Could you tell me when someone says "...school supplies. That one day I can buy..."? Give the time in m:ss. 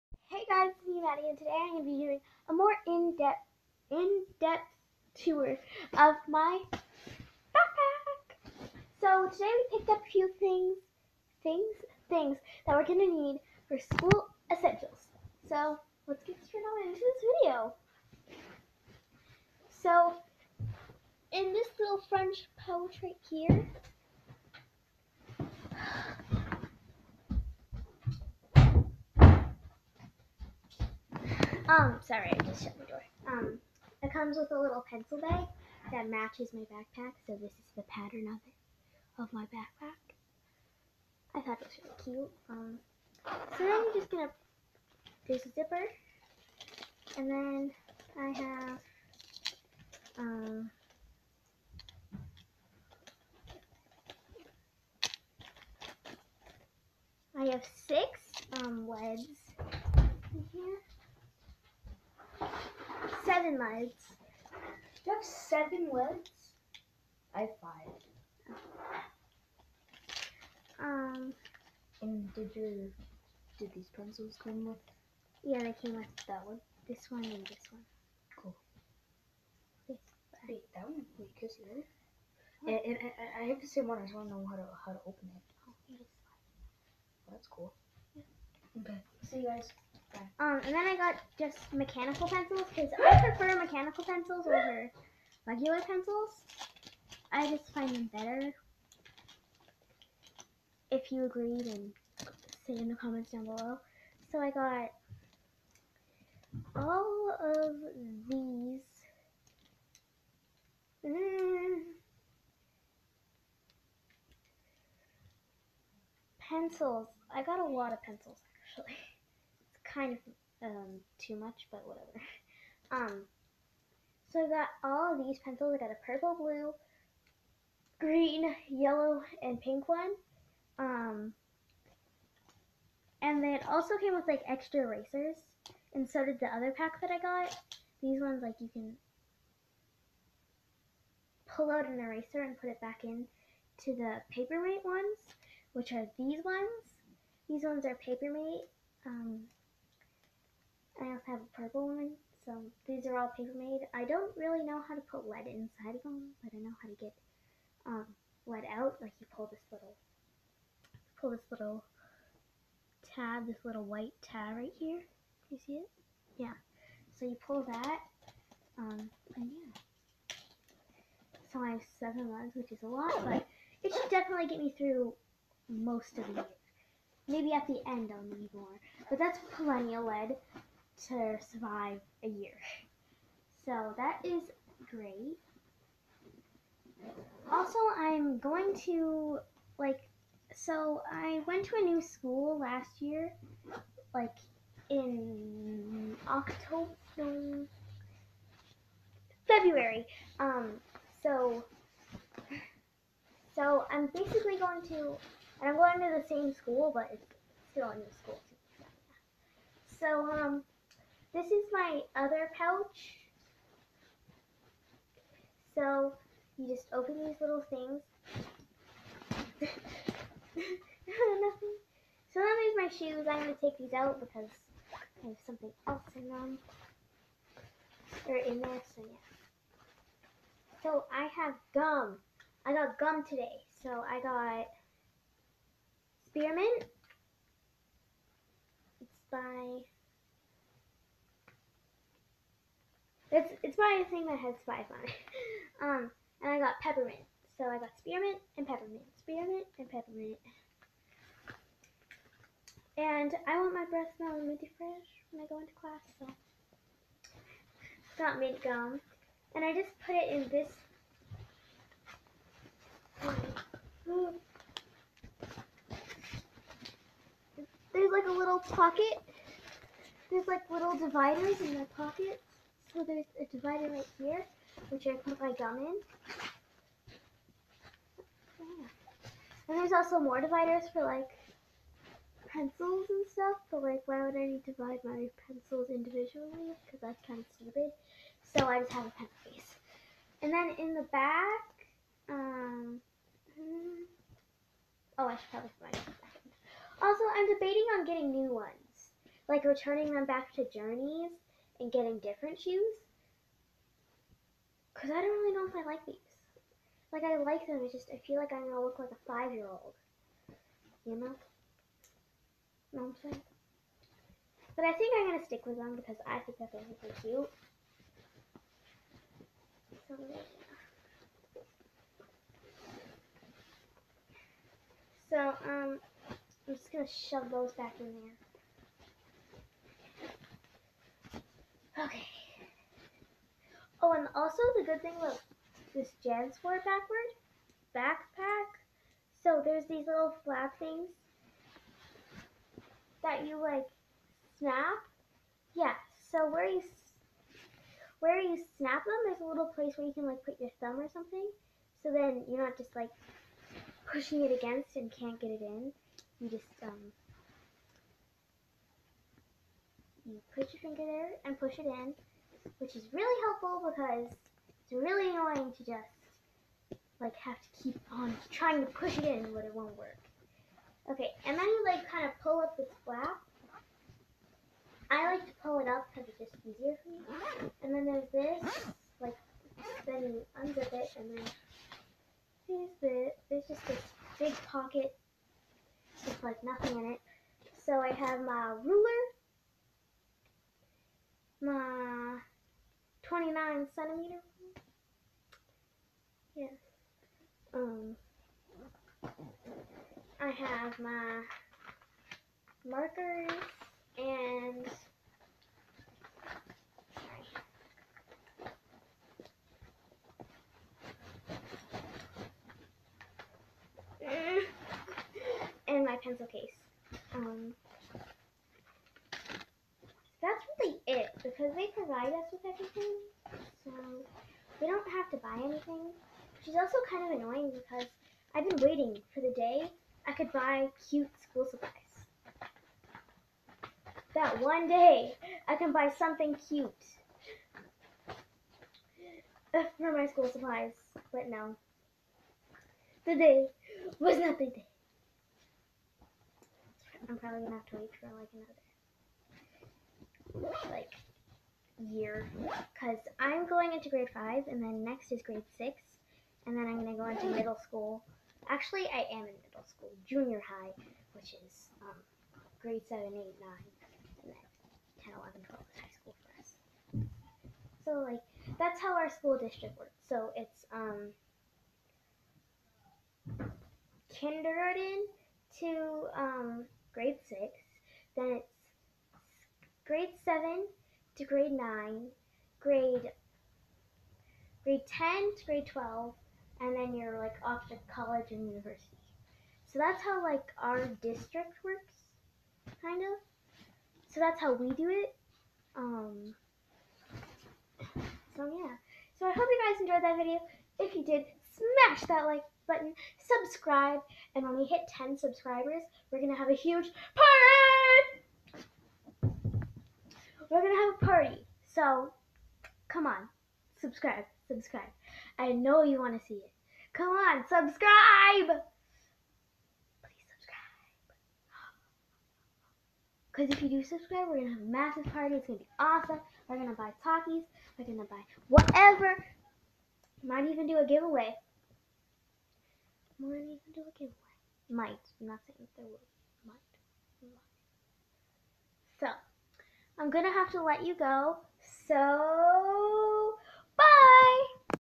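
7:11.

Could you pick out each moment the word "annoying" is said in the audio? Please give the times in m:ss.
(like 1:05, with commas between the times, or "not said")
6:05, 7:07.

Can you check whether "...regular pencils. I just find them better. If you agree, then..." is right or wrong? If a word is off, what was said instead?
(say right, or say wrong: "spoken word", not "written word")
right.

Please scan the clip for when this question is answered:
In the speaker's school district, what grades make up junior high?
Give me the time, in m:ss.
7:42.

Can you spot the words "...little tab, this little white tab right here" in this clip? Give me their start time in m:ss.
2:41.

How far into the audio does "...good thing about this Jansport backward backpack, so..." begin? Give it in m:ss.
5:34.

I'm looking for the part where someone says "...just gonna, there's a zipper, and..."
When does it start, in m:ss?
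0:43.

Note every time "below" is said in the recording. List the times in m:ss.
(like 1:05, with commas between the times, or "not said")
1:43.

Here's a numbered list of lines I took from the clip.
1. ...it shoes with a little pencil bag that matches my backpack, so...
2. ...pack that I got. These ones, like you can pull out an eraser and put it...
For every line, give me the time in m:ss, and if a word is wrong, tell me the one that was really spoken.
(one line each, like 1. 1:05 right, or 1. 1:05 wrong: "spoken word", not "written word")
1. 0:34 wrong: "comes", not "shoes"
2. 2:16 right.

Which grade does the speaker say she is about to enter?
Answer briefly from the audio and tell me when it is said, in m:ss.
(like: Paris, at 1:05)
Grade five, at 7:34.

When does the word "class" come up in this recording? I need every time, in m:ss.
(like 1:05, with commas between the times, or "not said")
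4:15.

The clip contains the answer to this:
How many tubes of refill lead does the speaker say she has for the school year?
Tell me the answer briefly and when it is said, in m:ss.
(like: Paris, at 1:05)
7, at 2:51.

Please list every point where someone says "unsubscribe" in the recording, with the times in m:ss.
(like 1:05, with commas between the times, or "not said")
not said.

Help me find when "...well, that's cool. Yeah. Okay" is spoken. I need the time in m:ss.
1:25.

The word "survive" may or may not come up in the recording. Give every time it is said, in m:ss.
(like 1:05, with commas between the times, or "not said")
3:01.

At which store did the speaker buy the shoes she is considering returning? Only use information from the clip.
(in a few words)
Journeys.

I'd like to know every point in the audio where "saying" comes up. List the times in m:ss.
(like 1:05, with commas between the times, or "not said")
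5:13, 8:55.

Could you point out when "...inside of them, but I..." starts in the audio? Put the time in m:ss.
2:35.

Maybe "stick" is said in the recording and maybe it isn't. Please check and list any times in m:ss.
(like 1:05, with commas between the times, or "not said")
5:15.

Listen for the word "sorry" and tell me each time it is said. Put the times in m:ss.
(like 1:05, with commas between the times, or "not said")
0:32, 6:47.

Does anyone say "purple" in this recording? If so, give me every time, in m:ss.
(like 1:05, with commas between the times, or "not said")
2:06, 2:31.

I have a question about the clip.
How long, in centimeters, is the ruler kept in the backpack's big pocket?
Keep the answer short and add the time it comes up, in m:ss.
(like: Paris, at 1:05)
29 centimeters, at 6:33.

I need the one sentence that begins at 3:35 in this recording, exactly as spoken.
So you just open these little things.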